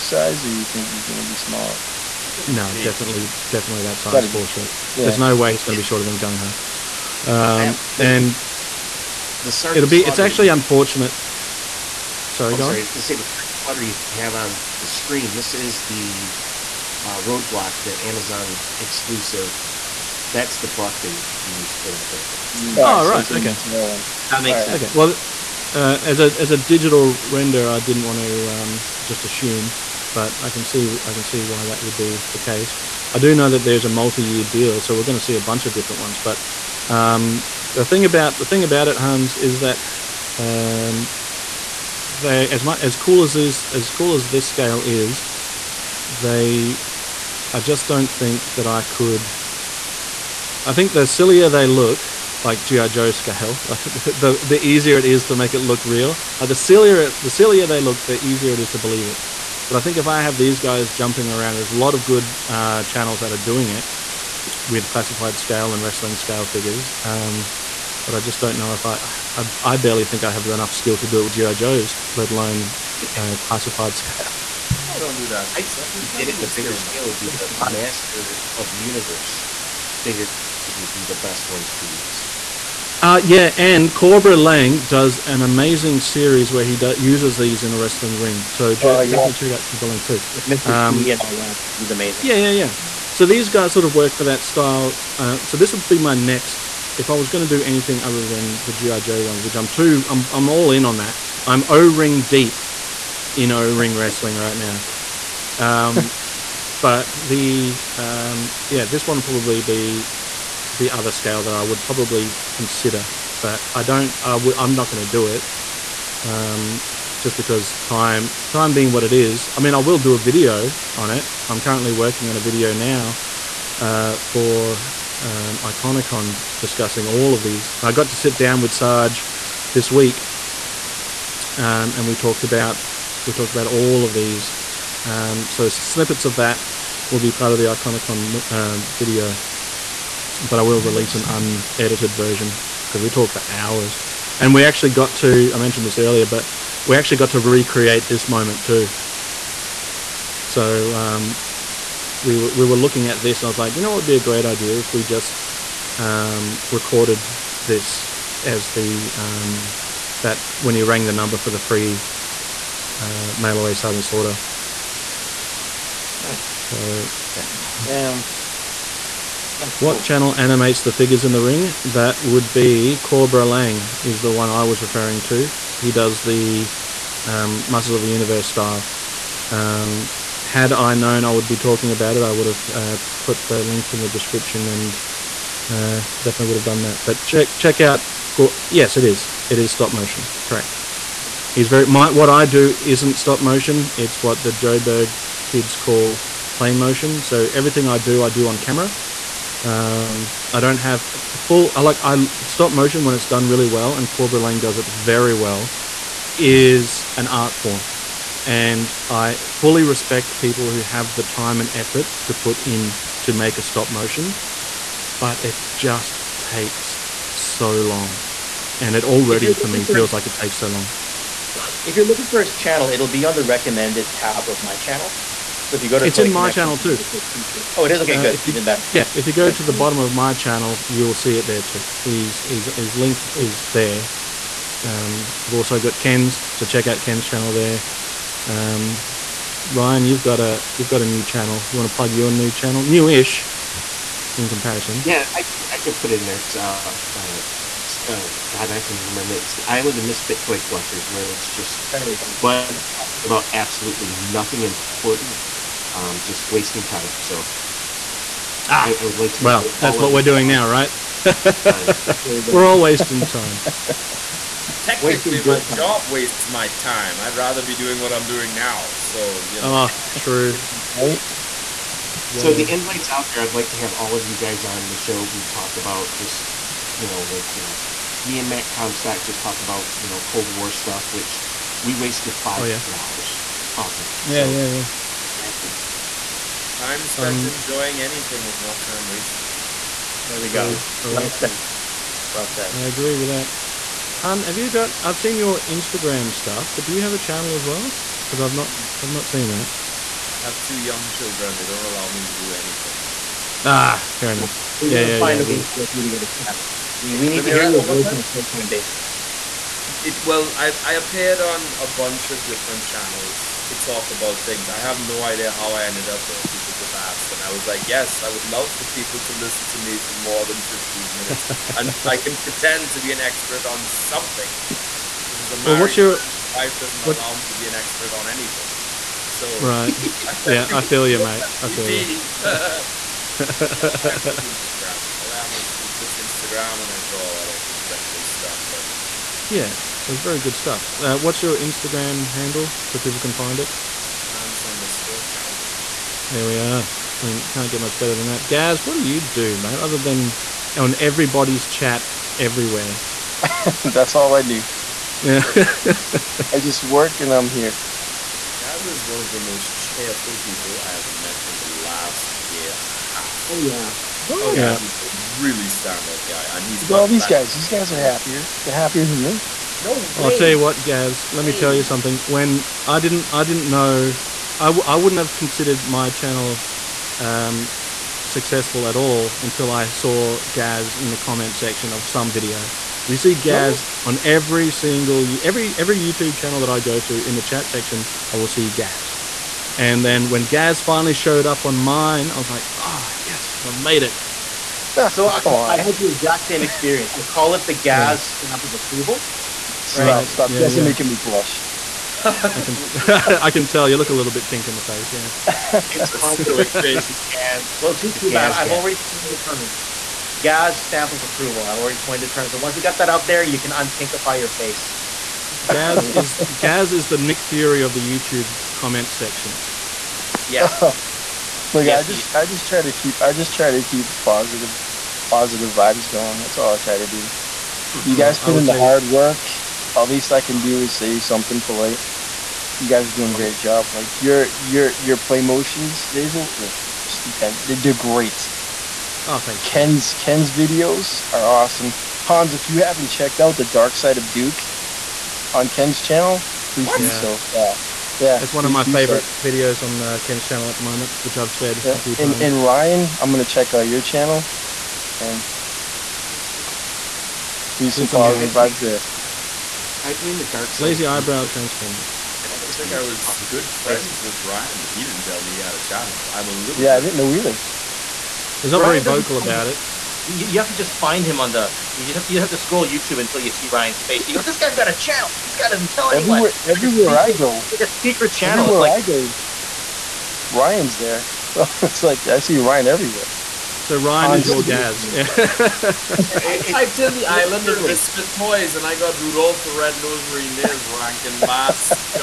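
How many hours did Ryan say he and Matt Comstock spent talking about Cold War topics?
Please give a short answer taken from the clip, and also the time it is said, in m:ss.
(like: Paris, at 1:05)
5, at 4:42.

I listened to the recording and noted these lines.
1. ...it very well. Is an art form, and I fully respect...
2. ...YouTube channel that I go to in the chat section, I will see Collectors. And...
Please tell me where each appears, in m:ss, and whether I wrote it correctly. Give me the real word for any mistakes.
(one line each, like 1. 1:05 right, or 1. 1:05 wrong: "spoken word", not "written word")
1. 3:24 right
2. 6:25 wrong: "Gaz", not "Collectors".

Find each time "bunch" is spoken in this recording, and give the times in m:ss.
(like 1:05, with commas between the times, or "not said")
0:35, 5:11.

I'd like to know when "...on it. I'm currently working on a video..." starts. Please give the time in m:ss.
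2:00.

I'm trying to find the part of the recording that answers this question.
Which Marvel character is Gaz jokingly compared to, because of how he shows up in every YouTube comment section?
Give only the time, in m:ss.
6:57.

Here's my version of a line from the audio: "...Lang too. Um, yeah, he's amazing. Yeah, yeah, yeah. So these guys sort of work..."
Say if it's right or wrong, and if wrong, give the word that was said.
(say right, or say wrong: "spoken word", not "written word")
right.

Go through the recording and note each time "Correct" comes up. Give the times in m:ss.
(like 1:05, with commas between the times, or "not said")
3:10, 4:51.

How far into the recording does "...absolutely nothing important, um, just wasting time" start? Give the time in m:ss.
4:13.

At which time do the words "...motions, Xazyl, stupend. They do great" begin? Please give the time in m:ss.
7:15.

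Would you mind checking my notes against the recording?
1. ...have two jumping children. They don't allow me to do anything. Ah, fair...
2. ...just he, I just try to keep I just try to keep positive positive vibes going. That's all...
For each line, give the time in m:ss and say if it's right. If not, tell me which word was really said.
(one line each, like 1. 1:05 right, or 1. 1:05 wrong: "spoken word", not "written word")
1. 5:00 wrong: "young", not "jumping"
2. 7:02 right.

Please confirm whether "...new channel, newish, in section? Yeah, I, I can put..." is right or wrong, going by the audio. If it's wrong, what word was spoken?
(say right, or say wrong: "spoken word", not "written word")
wrong: "comparison", not "section".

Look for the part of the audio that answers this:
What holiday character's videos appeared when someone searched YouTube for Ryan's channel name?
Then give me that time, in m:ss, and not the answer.
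8:09.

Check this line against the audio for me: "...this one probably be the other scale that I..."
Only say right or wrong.
right.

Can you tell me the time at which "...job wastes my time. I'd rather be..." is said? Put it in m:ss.
4:25.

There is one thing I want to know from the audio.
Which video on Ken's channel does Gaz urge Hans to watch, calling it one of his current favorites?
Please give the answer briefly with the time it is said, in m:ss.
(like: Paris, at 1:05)
The Dark Side of Duke, at 7:23.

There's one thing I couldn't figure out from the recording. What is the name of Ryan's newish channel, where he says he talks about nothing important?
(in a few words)
Island of Misfit Toy Collectors.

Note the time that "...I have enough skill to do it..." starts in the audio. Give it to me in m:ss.
1:10.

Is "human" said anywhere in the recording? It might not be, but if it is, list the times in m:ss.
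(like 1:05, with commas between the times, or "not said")
not said.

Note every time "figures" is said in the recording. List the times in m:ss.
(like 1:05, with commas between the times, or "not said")
1:06, 1:20, 2:50.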